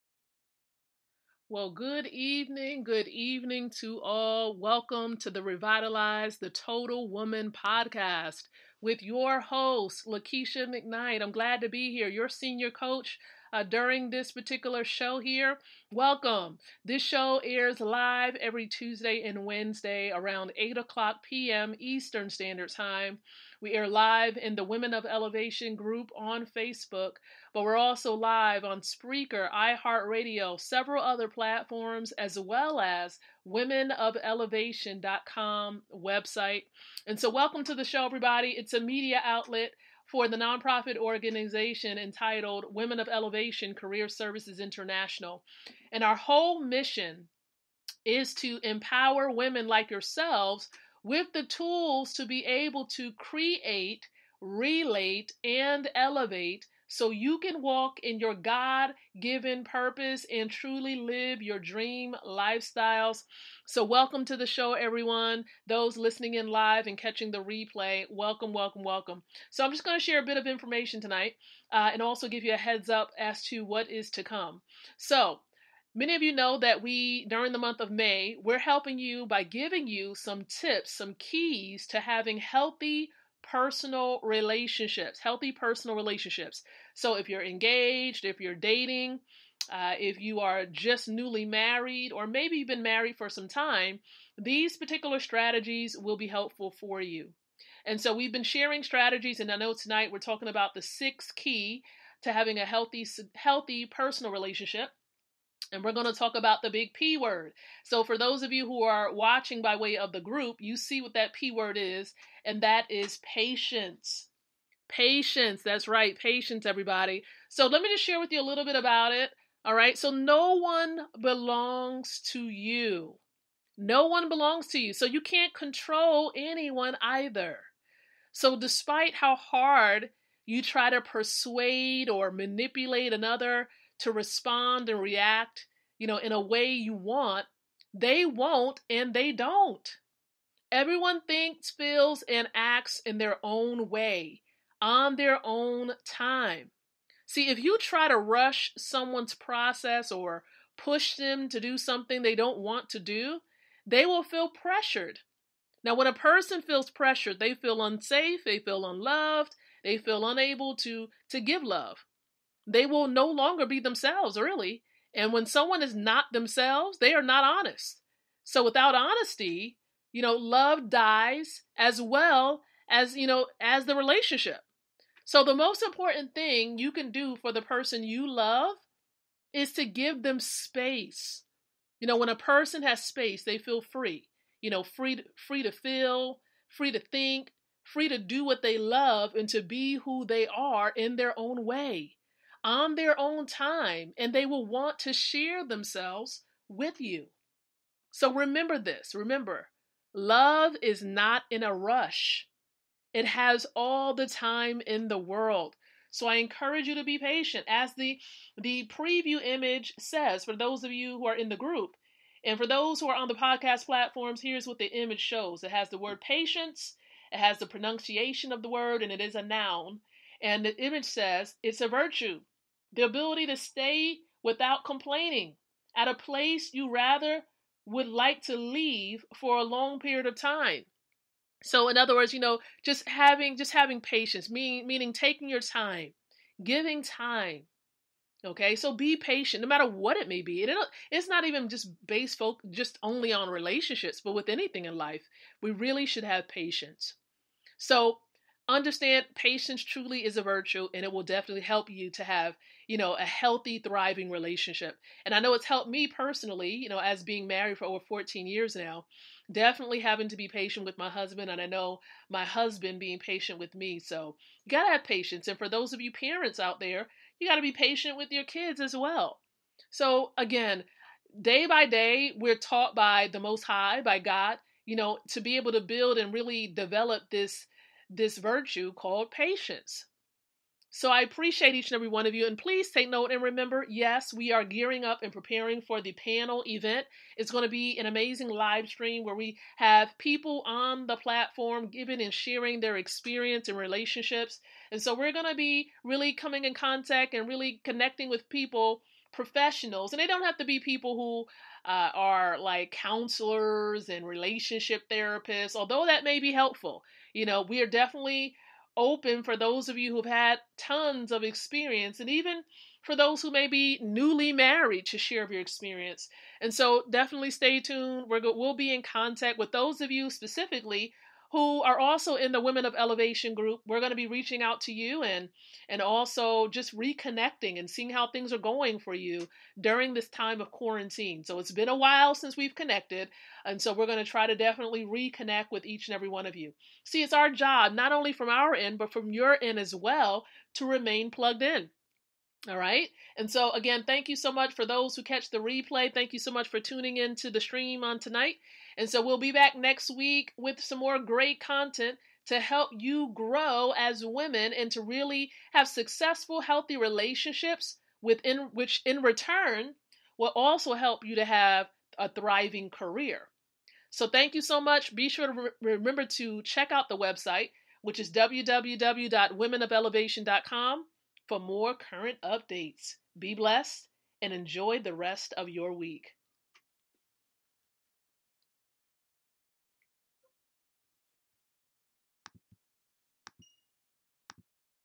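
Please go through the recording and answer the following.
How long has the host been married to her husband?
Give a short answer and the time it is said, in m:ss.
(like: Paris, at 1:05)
Over 14 years, at 4:17.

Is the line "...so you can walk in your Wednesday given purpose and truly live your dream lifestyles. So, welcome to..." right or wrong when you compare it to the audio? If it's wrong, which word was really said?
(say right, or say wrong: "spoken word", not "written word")
wrong: "God", not "Wednesday".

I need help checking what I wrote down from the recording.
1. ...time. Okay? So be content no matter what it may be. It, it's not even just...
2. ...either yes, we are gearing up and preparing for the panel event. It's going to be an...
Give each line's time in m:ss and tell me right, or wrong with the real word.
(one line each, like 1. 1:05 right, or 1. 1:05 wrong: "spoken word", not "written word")
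1. 3:57 wrong: "patient", not "content"
2. 4:43 wrong: "remember", not "either".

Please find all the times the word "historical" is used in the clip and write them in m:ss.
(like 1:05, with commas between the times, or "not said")
not said.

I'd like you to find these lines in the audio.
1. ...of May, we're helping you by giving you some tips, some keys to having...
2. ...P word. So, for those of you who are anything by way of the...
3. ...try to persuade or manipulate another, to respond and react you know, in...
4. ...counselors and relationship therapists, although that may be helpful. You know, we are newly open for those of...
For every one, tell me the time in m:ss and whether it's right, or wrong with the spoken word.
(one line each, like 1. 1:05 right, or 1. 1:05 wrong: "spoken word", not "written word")
1. 1:17 right
2. 1:46 wrong: "watching", not "anything"
3. 2:10 right
4. 5:02 wrong: "definitely", not "newly".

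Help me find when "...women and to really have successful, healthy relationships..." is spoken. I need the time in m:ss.
5:54.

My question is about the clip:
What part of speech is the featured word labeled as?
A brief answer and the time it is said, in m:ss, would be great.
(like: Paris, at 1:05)
Noun, at 3:39.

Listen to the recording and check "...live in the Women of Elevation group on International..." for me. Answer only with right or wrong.
wrong.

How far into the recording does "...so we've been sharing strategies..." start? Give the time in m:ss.
1:37.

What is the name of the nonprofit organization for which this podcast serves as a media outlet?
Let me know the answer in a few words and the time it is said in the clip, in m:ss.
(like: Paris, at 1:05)
Women of Elevation Career Services International, at 0:42.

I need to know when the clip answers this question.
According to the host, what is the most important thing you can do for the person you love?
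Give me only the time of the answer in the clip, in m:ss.
2:59.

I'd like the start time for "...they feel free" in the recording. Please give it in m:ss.
3:03.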